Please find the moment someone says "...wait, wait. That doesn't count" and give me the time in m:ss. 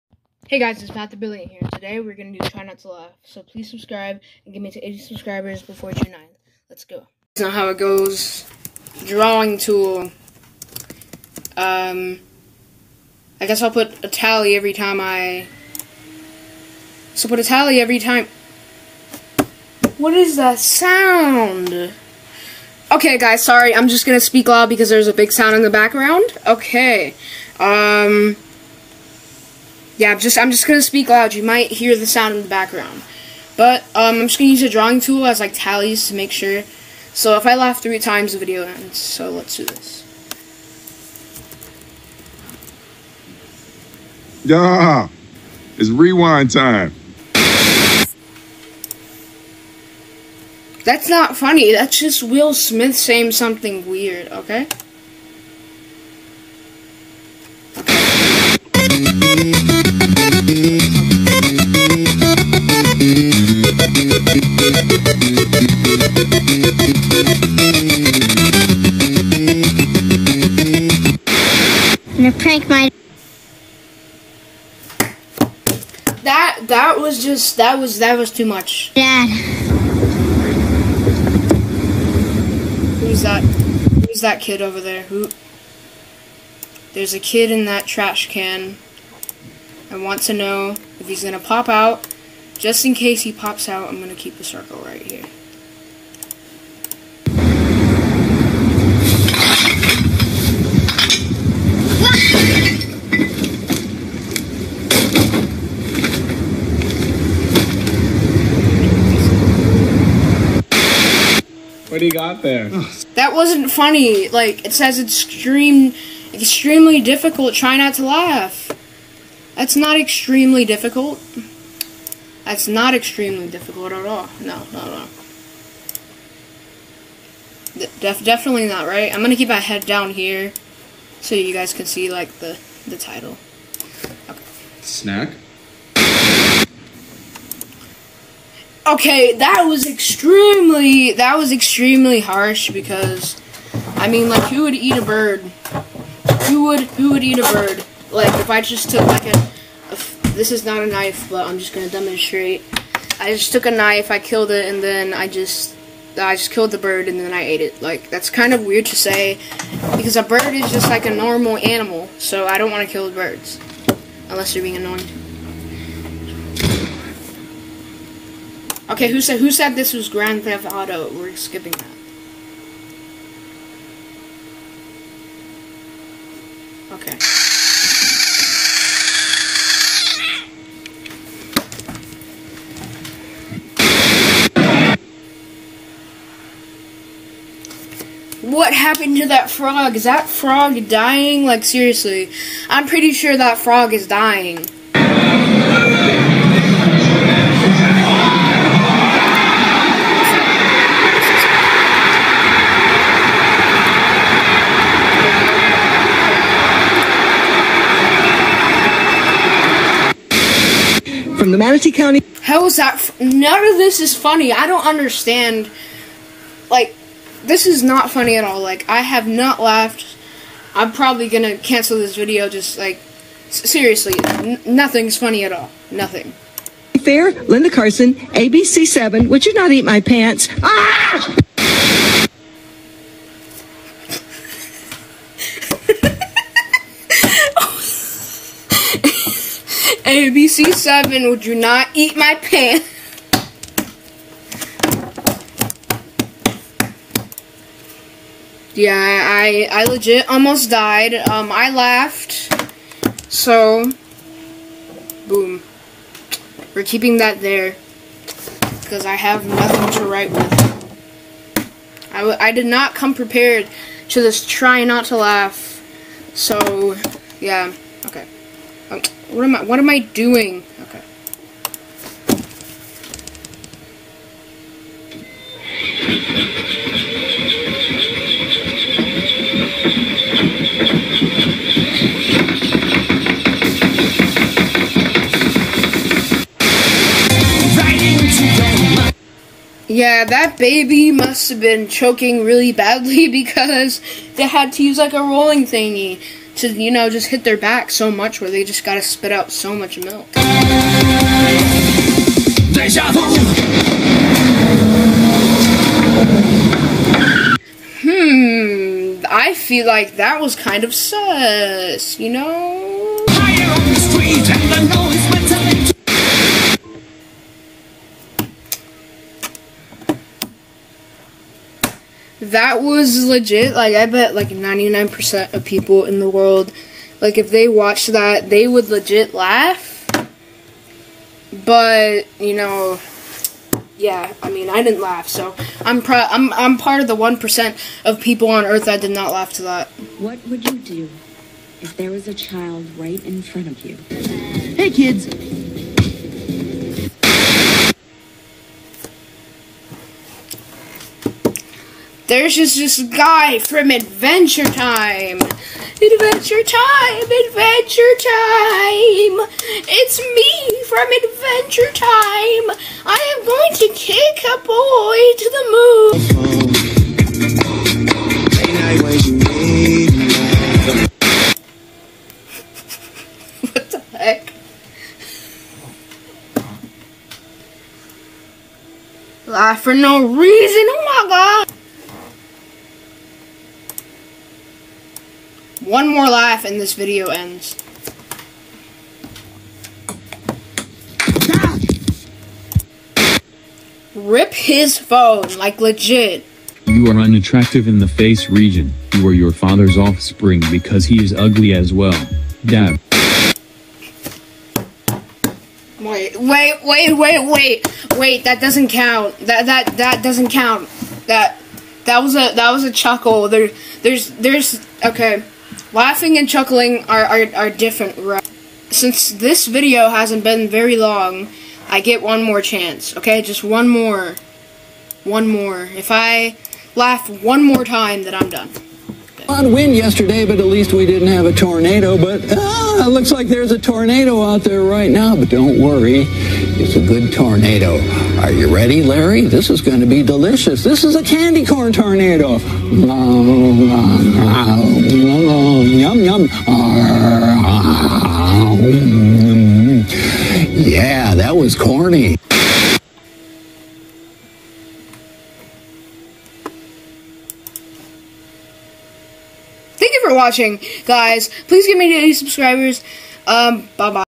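6:47.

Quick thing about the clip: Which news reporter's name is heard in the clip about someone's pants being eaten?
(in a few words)
Linda Carson.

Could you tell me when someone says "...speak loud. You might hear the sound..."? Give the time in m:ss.
0:30.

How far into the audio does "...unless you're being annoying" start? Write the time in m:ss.
2:44.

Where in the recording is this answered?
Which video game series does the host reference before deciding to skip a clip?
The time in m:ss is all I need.
2:50.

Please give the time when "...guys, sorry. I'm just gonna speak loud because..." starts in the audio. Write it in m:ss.
0:23.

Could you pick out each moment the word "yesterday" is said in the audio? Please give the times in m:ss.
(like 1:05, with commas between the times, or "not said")
7:09.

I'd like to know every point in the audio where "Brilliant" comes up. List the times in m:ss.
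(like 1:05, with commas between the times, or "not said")
0:01.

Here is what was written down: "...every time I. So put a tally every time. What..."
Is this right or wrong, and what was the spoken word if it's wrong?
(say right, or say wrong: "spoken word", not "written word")
right.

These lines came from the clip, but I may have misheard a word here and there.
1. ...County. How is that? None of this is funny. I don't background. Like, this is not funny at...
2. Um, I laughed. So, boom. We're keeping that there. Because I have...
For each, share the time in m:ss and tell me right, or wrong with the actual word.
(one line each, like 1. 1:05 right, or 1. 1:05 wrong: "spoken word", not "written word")
1. 3:31 wrong: "understand", not "background"
2. 4:11 right.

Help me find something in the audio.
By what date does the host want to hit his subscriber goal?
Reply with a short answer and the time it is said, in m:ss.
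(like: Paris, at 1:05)
June 9th, at 0:05.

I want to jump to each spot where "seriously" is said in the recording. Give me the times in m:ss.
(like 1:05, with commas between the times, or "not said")
3:11, 3:43.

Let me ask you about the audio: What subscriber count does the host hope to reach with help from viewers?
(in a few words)
80.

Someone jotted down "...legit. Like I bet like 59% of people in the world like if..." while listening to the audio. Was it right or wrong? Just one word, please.
wrong.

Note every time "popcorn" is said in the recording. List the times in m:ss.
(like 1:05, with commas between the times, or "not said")
not said.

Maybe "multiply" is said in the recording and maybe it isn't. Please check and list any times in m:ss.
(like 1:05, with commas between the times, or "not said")
not said.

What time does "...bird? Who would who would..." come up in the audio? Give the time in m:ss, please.
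2:25.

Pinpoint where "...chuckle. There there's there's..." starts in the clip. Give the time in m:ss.
6:52.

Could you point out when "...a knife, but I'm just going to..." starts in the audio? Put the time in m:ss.
2:30.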